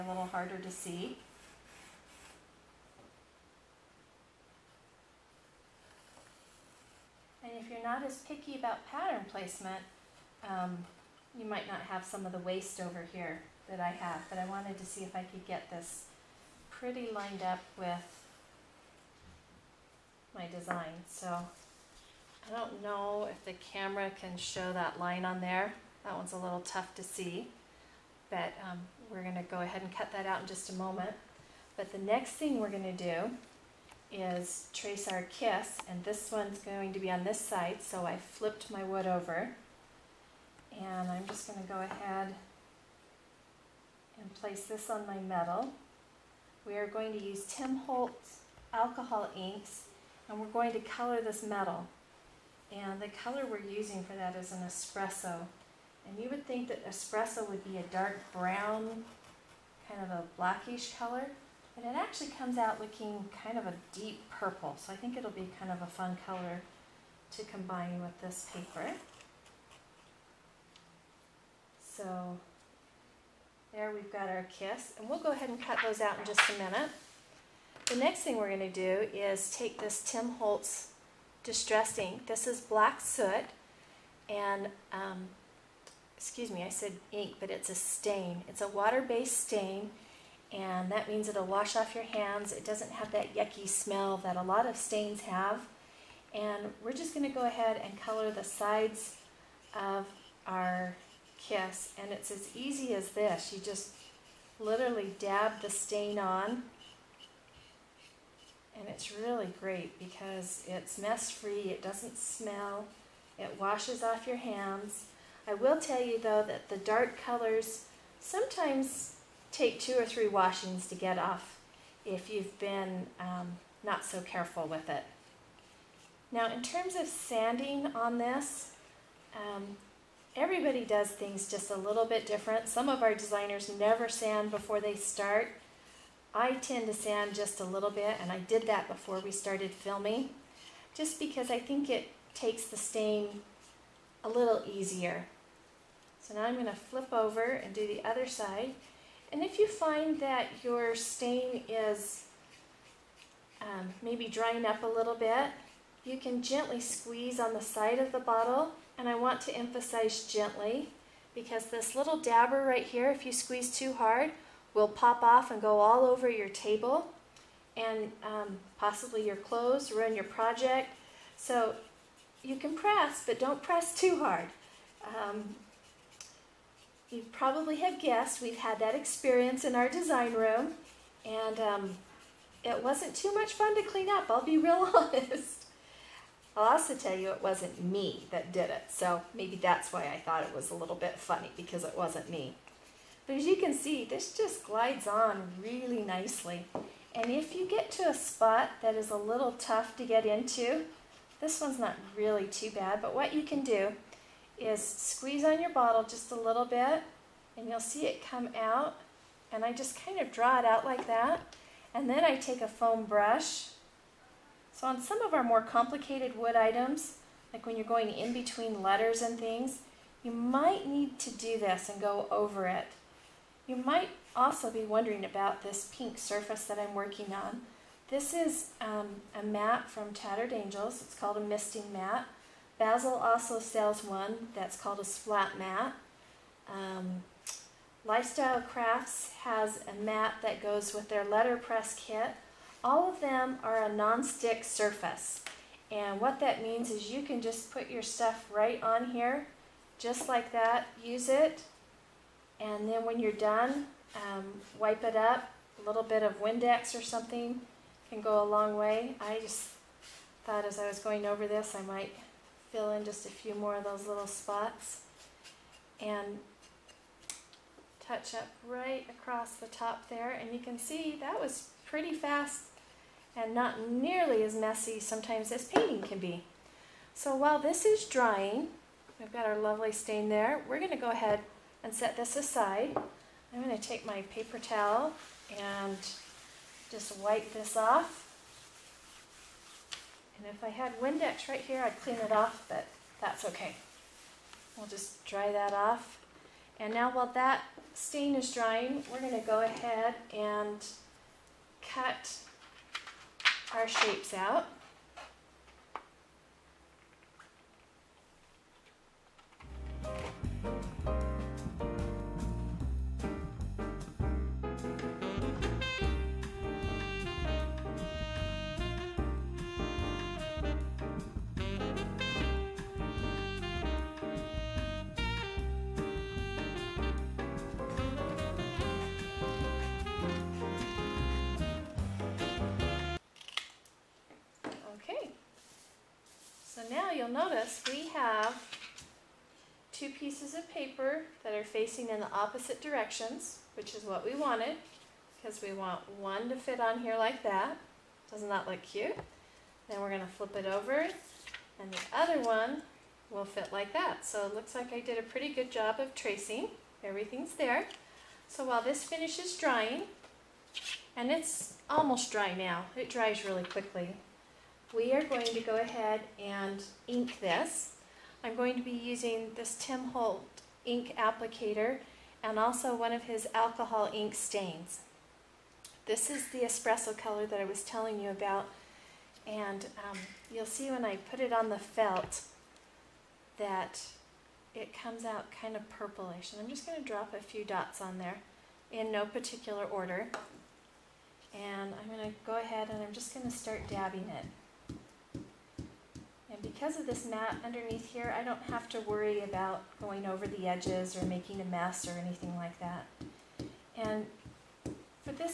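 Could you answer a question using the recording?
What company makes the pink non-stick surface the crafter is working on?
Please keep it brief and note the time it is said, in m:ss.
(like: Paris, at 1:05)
Tattered Angels, at 3:50.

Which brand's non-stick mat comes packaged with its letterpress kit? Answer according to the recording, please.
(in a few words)
Lifestyle Crafts.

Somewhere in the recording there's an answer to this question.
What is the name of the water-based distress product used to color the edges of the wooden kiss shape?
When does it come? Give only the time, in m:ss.
1:22.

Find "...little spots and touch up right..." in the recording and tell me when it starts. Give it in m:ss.
4:24.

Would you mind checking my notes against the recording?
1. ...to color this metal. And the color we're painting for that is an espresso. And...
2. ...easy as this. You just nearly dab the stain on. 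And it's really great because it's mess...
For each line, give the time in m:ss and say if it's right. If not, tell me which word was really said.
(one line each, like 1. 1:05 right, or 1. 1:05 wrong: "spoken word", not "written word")
1. 0:50 wrong: "using", not "painting"
2. 1:42 wrong: "literally", not "nearly".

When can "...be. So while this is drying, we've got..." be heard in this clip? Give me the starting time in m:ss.
4:36.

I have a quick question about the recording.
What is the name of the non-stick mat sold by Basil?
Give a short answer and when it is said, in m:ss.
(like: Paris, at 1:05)
splat mat, at 3:55.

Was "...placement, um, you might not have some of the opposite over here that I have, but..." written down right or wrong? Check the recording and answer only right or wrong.
wrong.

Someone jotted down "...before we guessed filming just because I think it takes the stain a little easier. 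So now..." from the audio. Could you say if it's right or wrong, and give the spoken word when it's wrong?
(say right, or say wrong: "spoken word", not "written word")
wrong: "started", not "guessed".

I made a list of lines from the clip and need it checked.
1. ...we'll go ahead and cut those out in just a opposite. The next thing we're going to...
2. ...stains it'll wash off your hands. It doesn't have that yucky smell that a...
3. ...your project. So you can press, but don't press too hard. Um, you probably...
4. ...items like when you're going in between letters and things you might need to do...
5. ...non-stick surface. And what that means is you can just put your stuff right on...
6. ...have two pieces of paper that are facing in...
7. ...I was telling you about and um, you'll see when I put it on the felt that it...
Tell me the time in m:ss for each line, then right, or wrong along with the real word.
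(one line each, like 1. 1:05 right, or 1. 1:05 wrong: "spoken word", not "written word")
1. 1:15 wrong: "minute", not "opposite"
2. 1:31 wrong: "means", not "stains"
3. 2:50 right
4. 3:36 right
5. 4:03 right
6. 5:38 right
7. 6:17 right.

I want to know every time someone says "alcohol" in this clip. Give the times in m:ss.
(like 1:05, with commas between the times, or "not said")
0:48, 6:13.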